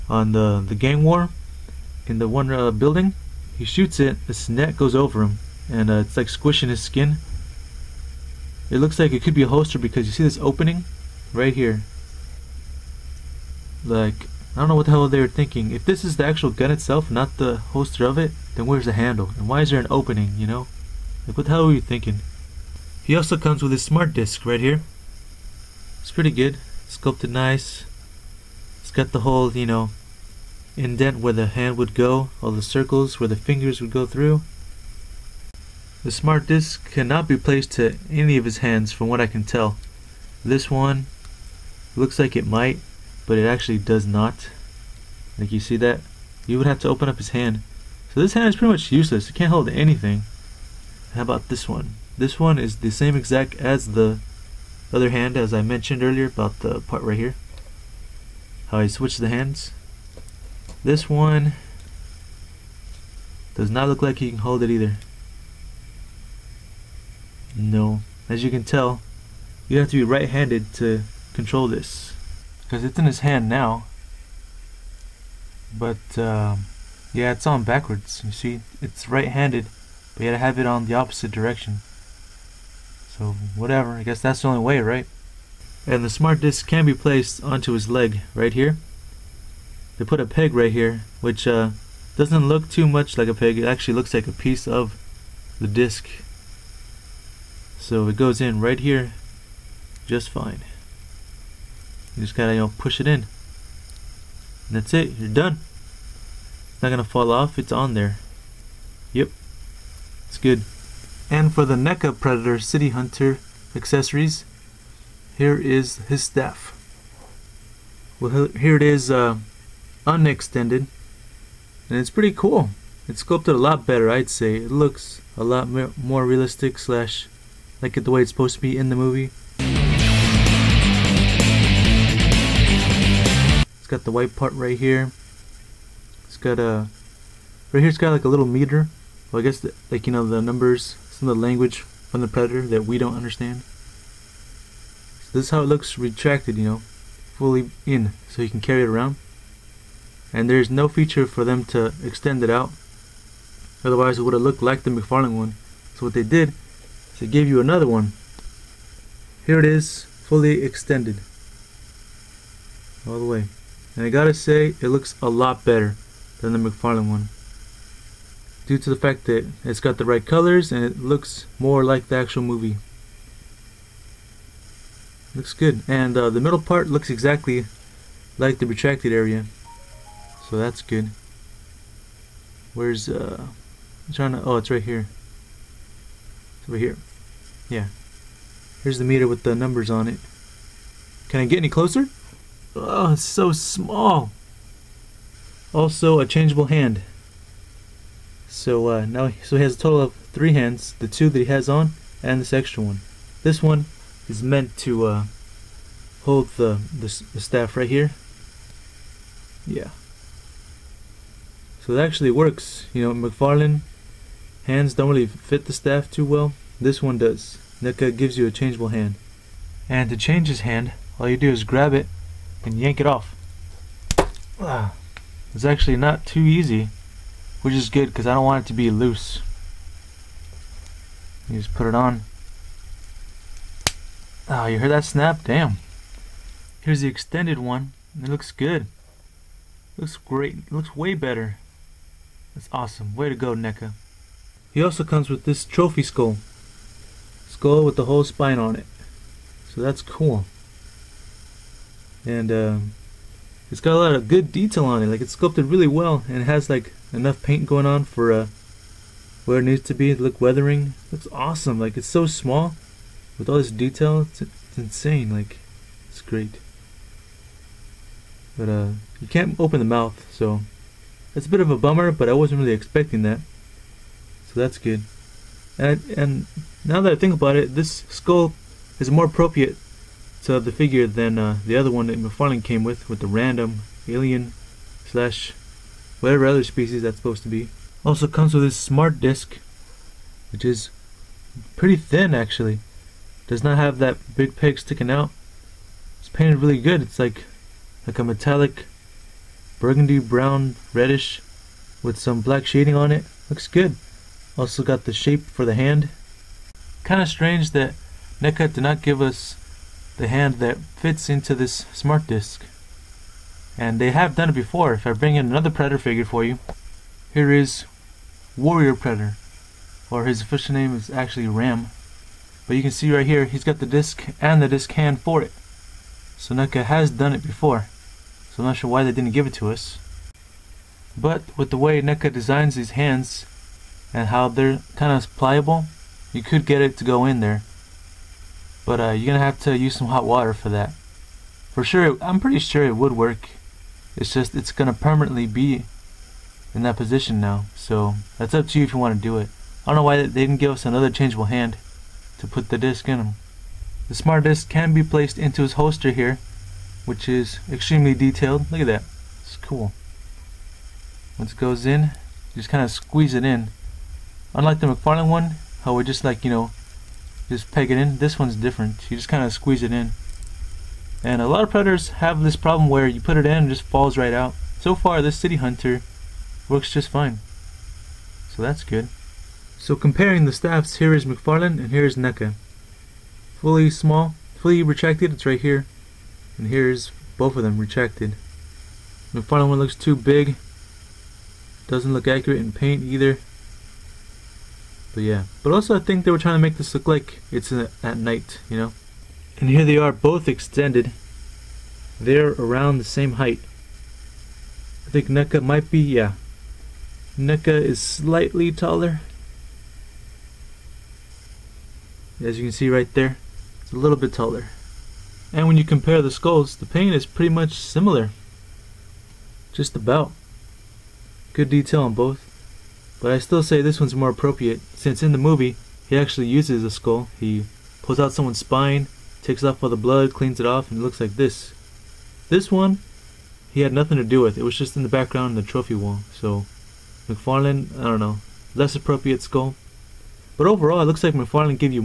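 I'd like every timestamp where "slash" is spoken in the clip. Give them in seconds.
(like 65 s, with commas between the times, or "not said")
126 s, 285 s.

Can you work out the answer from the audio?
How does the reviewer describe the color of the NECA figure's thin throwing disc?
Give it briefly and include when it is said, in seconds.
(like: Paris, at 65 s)
Metallic burgundy brown reddish, at 298 s.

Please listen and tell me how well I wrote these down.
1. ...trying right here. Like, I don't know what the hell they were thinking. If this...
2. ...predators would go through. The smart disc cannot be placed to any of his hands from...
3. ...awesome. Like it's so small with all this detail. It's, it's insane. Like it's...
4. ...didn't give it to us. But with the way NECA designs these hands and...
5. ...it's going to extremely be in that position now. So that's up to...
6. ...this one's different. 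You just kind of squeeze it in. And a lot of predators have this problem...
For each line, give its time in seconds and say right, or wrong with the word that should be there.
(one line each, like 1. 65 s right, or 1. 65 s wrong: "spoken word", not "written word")
1. 10 s wrong: "opening", not "trying"
2. 33 s wrong: "fingers", not "predators"
3. 261 s right
4. 329 s right
5. 344 s wrong: "permanently", not "extremely"
6. 368 s right.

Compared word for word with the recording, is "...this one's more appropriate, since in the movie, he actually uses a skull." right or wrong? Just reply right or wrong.
right.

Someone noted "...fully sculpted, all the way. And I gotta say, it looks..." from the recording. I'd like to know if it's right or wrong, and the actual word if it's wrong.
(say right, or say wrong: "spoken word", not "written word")
wrong: "extended", not "sculpted".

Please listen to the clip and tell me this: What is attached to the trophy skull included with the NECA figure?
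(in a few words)
The whole spine.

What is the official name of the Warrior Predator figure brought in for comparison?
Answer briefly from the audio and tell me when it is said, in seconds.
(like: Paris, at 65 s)
Ram, at 321 s.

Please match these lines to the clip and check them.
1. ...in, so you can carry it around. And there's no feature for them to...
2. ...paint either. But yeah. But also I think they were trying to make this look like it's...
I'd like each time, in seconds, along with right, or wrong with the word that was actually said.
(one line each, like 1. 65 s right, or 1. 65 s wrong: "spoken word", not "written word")
1. 147 s right
2. 392 s right.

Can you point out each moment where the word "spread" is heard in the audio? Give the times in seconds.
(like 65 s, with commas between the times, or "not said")
not said.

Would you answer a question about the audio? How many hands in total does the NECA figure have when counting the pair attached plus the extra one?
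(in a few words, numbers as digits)
3.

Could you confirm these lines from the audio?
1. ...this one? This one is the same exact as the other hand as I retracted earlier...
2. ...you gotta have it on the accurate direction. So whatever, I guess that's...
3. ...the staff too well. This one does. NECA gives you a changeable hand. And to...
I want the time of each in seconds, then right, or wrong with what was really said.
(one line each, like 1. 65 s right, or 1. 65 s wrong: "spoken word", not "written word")
1. 51 s wrong: "mentioned", not "retracted"
2. 80 s wrong: "opposite", not "accurate"
3. 215 s right.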